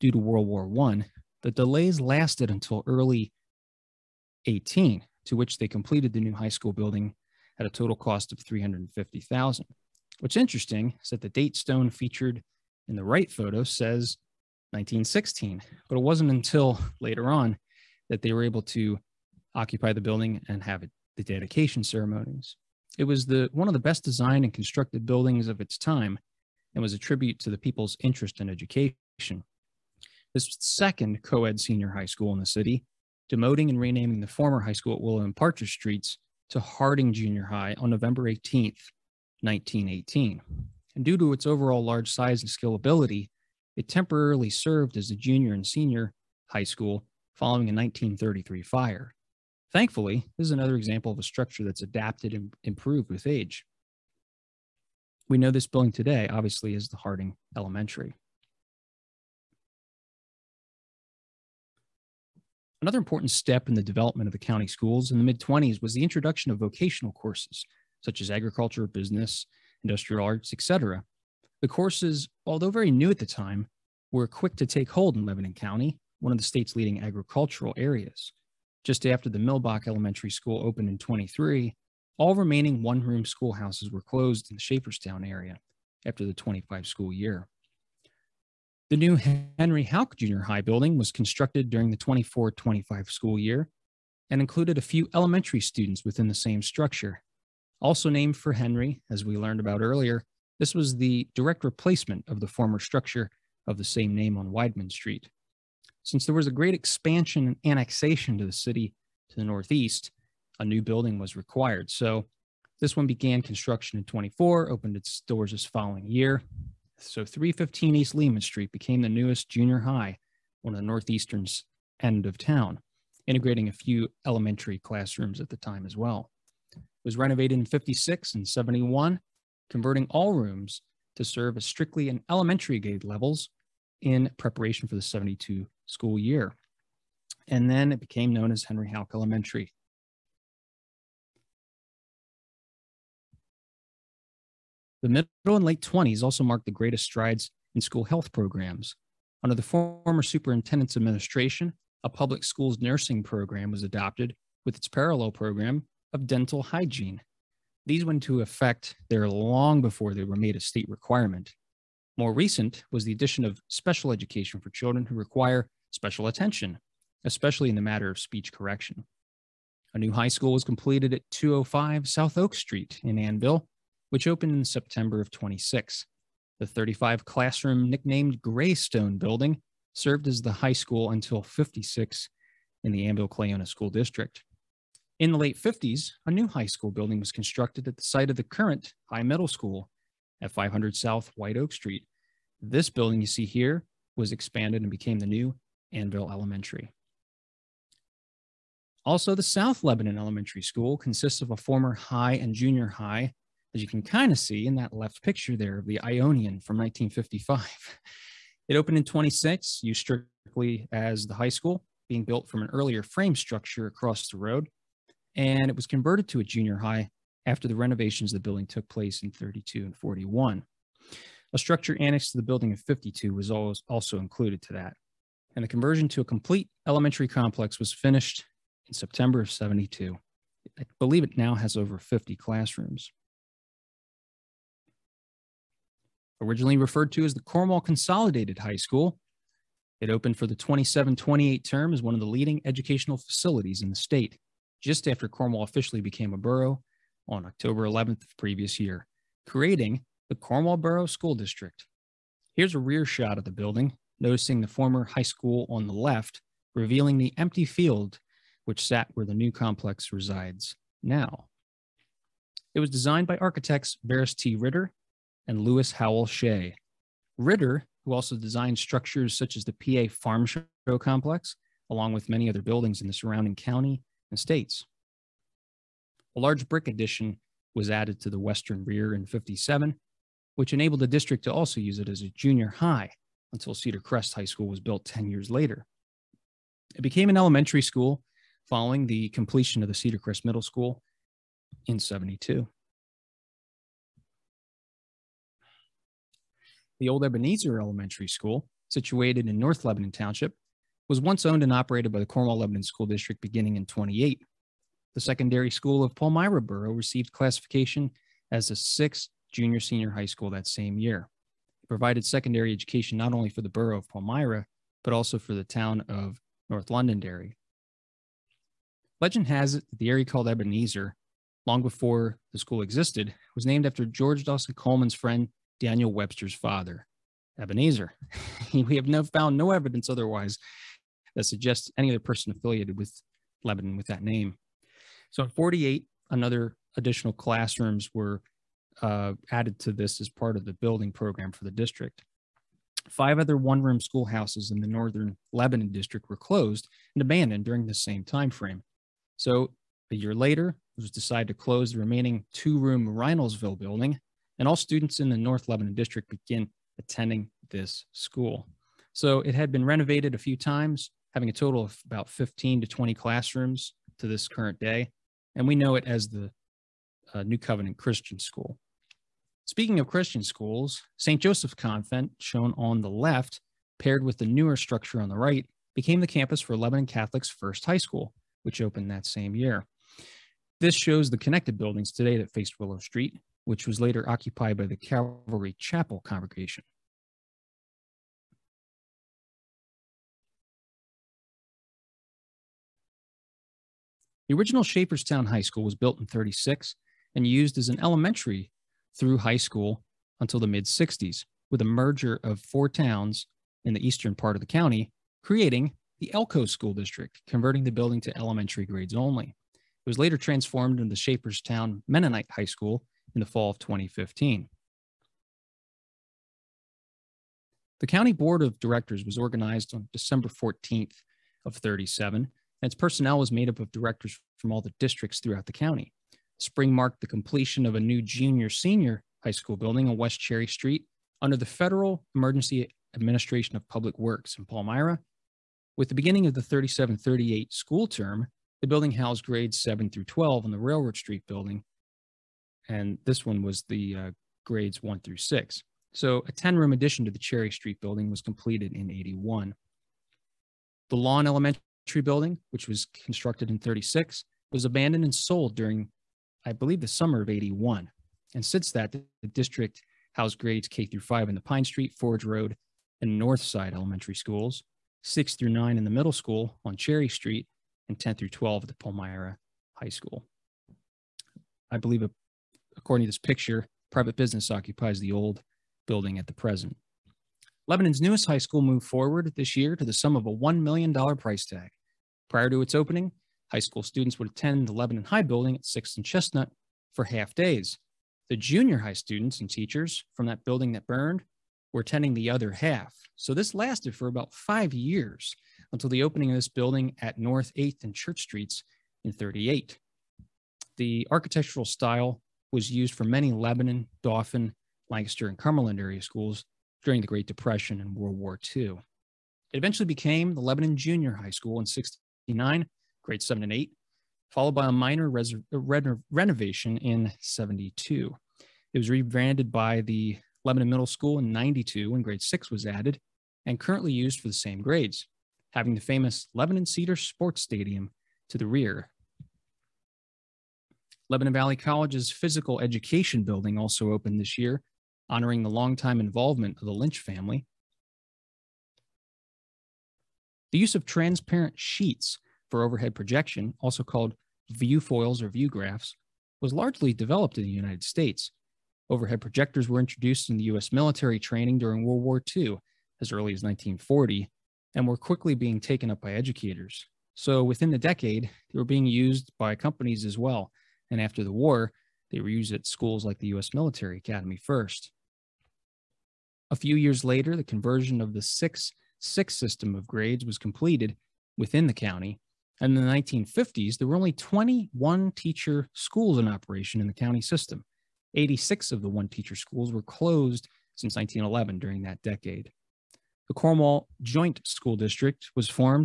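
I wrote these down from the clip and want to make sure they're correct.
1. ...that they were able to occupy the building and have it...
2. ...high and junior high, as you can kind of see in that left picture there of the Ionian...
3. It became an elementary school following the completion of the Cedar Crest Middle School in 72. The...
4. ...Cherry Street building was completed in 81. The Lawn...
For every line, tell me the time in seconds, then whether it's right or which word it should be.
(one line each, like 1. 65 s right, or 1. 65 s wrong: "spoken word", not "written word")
1. 18 s right
2. 201 s right
3. 286 s right
4. 447 s right.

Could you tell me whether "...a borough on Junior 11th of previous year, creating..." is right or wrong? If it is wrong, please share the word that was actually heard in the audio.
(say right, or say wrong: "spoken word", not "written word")
wrong: "October", not "Junior".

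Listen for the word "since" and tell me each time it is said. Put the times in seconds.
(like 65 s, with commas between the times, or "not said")
106 s, 458 s, 580 s.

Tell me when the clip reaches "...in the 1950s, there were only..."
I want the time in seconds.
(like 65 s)
572 s.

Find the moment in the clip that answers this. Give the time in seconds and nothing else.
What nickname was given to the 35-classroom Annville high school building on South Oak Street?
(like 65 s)
178 s.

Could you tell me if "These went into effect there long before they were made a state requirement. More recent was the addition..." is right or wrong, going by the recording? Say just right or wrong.
right.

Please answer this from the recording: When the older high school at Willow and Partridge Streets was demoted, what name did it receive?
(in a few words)
Harding Junior High.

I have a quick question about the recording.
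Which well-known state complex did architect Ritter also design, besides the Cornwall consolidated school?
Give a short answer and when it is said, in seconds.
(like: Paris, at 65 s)
PA Farm Show complex, at 269 s.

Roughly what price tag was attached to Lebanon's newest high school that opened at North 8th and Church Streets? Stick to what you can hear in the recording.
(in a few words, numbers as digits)
$1 million.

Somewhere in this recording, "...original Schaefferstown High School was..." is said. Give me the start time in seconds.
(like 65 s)
394 s.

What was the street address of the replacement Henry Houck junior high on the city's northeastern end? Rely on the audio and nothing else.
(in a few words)
315 East Lehman Street.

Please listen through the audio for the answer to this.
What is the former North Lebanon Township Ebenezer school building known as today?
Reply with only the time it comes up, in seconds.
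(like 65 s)
367 s.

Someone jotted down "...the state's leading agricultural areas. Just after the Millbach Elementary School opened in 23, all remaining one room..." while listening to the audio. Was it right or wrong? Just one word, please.
right.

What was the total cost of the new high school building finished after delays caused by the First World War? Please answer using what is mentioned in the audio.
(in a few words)
350,000.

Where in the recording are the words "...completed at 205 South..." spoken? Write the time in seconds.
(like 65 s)
170 s.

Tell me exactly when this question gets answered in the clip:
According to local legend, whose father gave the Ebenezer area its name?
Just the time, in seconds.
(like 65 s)
325 s.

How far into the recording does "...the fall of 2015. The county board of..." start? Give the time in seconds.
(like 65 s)
413 s.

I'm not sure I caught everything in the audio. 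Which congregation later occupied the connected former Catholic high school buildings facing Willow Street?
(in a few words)
Calvary Chapel.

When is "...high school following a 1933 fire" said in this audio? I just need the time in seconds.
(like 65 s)
46 s.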